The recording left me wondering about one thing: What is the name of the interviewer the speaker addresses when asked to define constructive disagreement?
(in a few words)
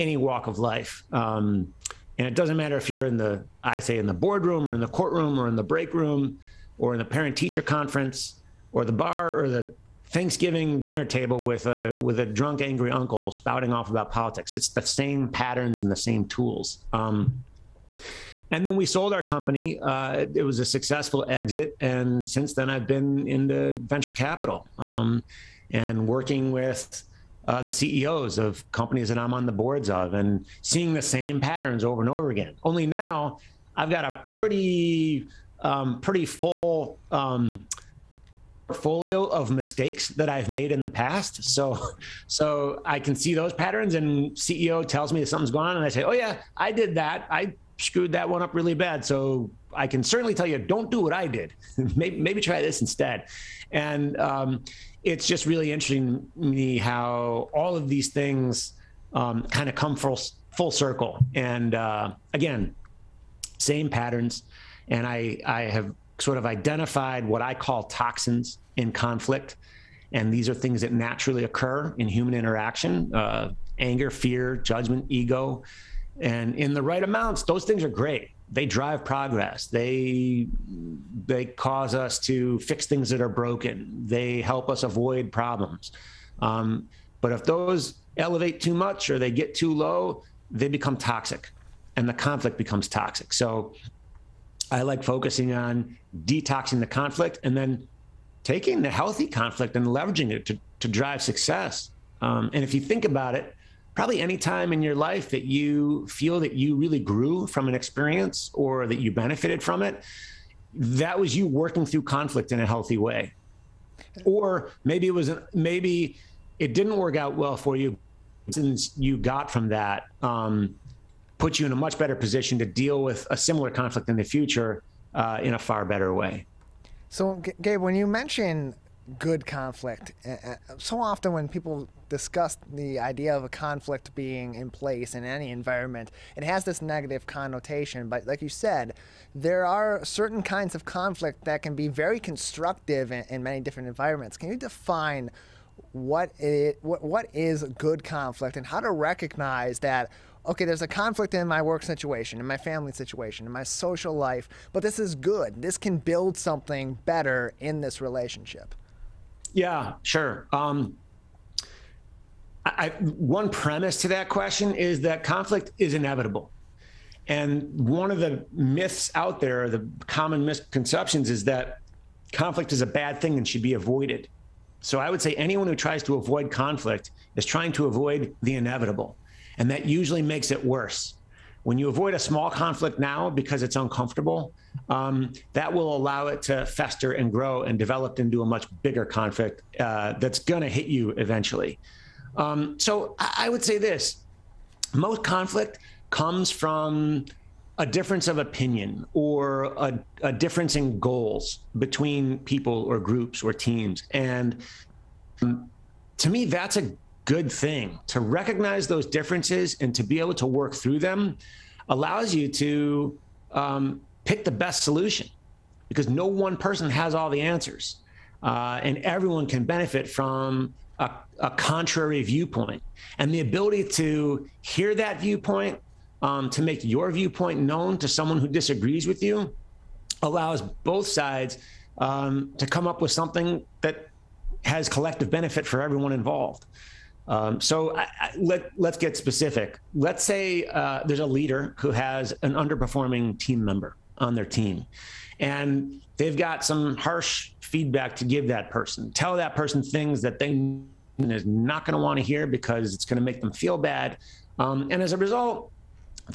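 Gabe.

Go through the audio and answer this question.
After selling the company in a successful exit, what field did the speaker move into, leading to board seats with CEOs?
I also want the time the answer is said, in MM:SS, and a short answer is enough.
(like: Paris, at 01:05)
venture capital, at 00:23.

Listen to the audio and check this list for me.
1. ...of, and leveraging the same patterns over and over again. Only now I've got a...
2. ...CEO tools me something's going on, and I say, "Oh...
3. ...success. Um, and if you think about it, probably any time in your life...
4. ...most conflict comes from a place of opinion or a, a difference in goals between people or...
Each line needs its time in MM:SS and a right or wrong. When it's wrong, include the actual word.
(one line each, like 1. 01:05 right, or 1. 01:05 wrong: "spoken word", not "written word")
1. 00:29 wrong: "seeing", not "leveraging"
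2. 00:44 wrong: "tells", not "tools"
3. 01:41 right
4. 03:14 wrong: "difference", not "place".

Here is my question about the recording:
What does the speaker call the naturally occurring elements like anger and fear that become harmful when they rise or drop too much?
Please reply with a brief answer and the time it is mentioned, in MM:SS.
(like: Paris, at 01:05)
toxins in conflict, at 01:07.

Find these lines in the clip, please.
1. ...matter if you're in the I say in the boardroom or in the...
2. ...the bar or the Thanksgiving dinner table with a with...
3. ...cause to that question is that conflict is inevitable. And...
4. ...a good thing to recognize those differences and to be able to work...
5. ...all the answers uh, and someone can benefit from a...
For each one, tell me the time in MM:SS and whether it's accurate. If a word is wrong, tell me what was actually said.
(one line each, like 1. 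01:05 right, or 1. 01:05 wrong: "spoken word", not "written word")
1. 00:02 right
2. 00:08 right
3. 02:43 wrong: "premise", not "cause"
4. 03:26 right
5. 03:37 wrong: "everyone", not "someone".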